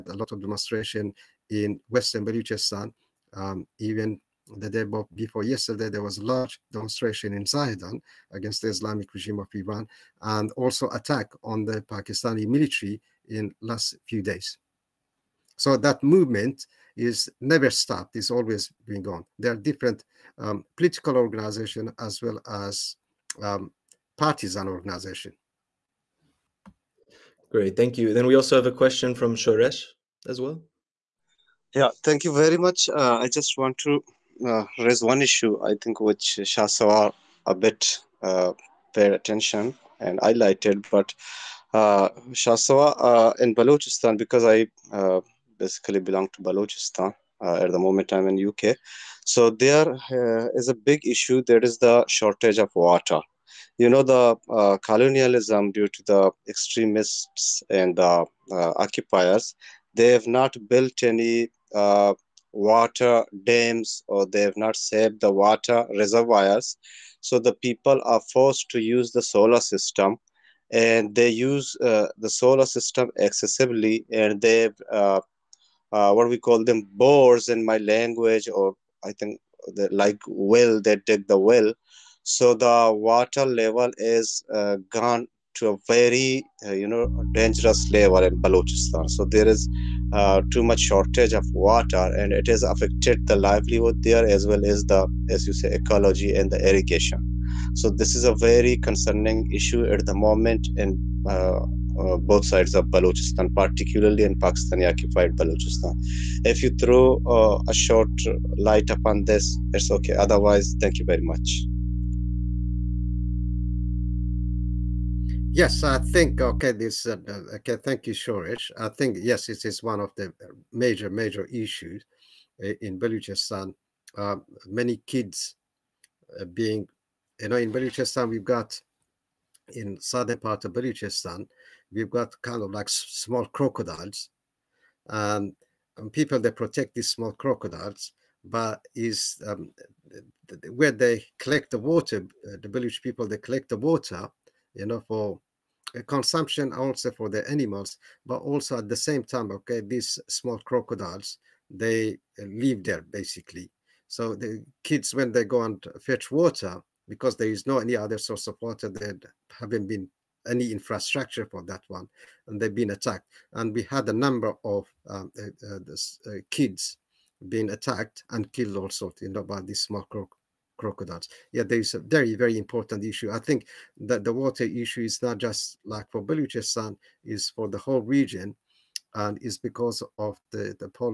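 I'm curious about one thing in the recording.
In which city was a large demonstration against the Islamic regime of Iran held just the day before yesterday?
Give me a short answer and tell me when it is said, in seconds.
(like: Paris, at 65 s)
Zahedan, at 7 s.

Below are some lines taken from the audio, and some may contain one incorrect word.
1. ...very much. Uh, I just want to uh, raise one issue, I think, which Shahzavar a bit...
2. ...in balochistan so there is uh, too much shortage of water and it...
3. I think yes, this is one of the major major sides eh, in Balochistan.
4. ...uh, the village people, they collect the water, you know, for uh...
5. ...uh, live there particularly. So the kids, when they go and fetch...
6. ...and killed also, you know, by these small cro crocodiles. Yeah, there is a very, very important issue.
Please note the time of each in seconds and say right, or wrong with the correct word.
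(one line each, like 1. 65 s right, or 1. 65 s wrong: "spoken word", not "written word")
1. 32 s right
2. 88 s right
3. 118 s wrong: "issues", not "sides"
4. 142 s right
5. 152 s wrong: "basically", not "particularly"
6. 168 s right.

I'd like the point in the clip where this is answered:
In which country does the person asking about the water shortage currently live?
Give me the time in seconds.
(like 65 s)
48 s.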